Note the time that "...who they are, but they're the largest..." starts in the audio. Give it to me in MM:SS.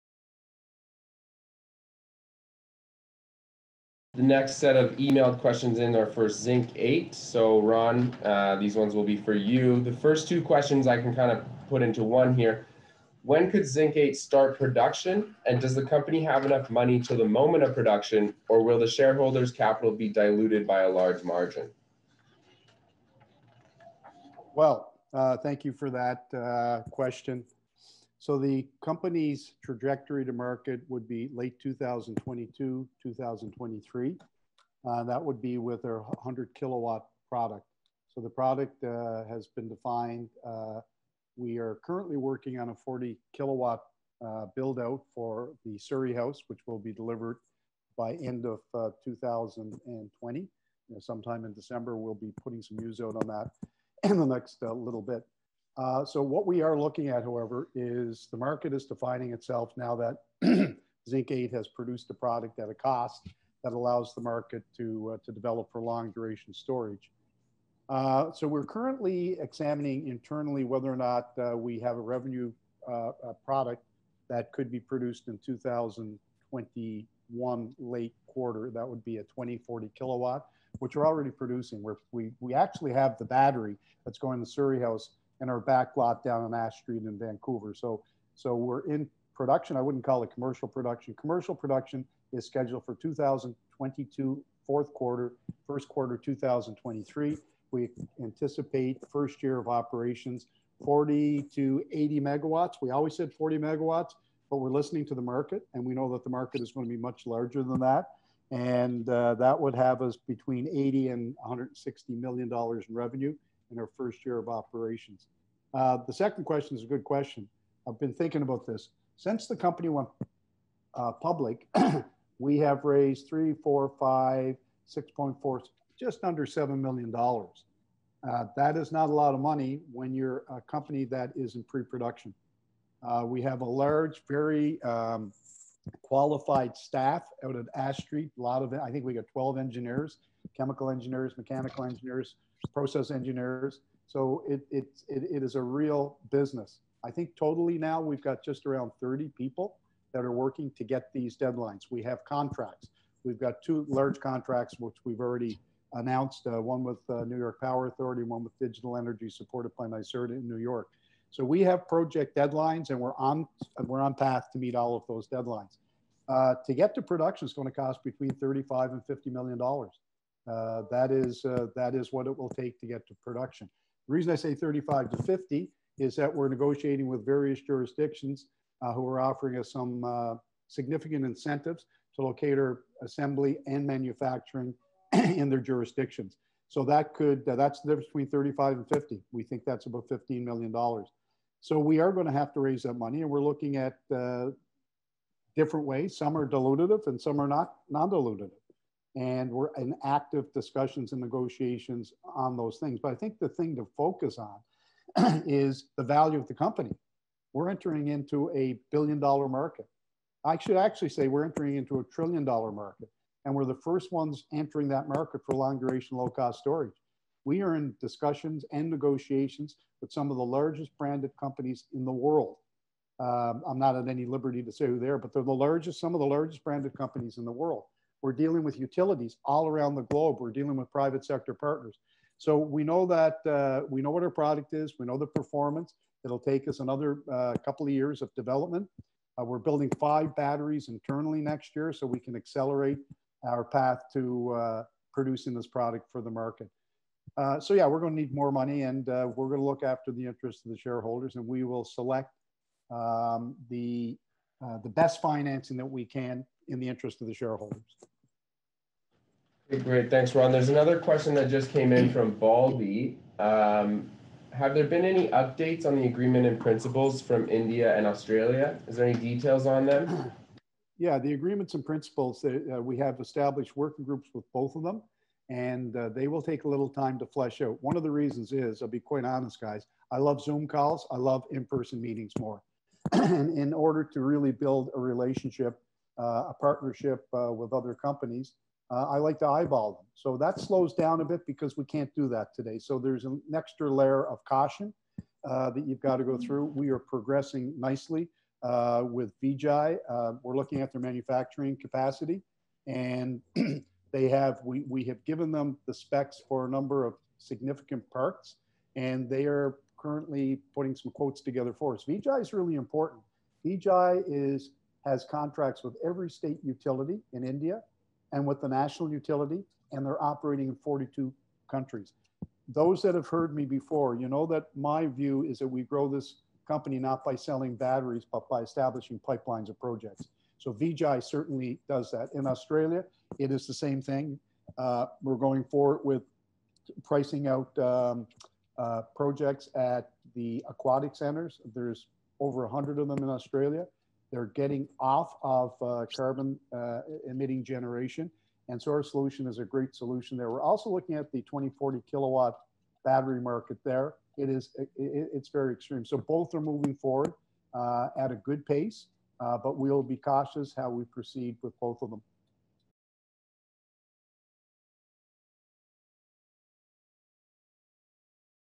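03:44.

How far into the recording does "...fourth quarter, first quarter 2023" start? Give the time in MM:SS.
01:34.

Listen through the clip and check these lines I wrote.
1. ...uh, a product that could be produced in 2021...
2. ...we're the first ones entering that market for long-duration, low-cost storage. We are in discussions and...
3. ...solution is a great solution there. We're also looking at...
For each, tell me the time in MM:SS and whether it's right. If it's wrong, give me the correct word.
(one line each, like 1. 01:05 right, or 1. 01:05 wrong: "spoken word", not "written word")
1. 01:12 right
2. 03:33 right
3. 05:49 right.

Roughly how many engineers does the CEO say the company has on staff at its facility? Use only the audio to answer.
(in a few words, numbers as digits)
12.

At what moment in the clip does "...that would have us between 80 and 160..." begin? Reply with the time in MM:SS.
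01:49.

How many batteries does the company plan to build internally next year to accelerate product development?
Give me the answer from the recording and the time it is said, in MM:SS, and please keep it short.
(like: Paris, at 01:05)
5, at 03:59.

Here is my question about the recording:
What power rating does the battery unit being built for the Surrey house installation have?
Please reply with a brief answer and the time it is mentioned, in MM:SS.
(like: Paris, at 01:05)
40 kilowatt, at 00:42.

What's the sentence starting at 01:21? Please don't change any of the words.
We're, we, we actually have the battery that's going to Surrey House and our back lot down on Ash Street in Vancouver.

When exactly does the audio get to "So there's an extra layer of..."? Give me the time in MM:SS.
04:52.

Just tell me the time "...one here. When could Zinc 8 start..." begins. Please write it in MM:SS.
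00:12.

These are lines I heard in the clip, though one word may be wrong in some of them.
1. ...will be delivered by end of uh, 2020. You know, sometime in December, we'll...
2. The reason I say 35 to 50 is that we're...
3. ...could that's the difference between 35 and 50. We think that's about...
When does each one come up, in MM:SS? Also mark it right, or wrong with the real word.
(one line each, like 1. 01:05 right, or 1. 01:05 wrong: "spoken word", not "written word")
1. 00:46 right
2. 02:54 right
3. 03:07 right.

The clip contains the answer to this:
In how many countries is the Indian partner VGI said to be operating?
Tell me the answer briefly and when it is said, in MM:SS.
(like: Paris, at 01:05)
42, at 05:20.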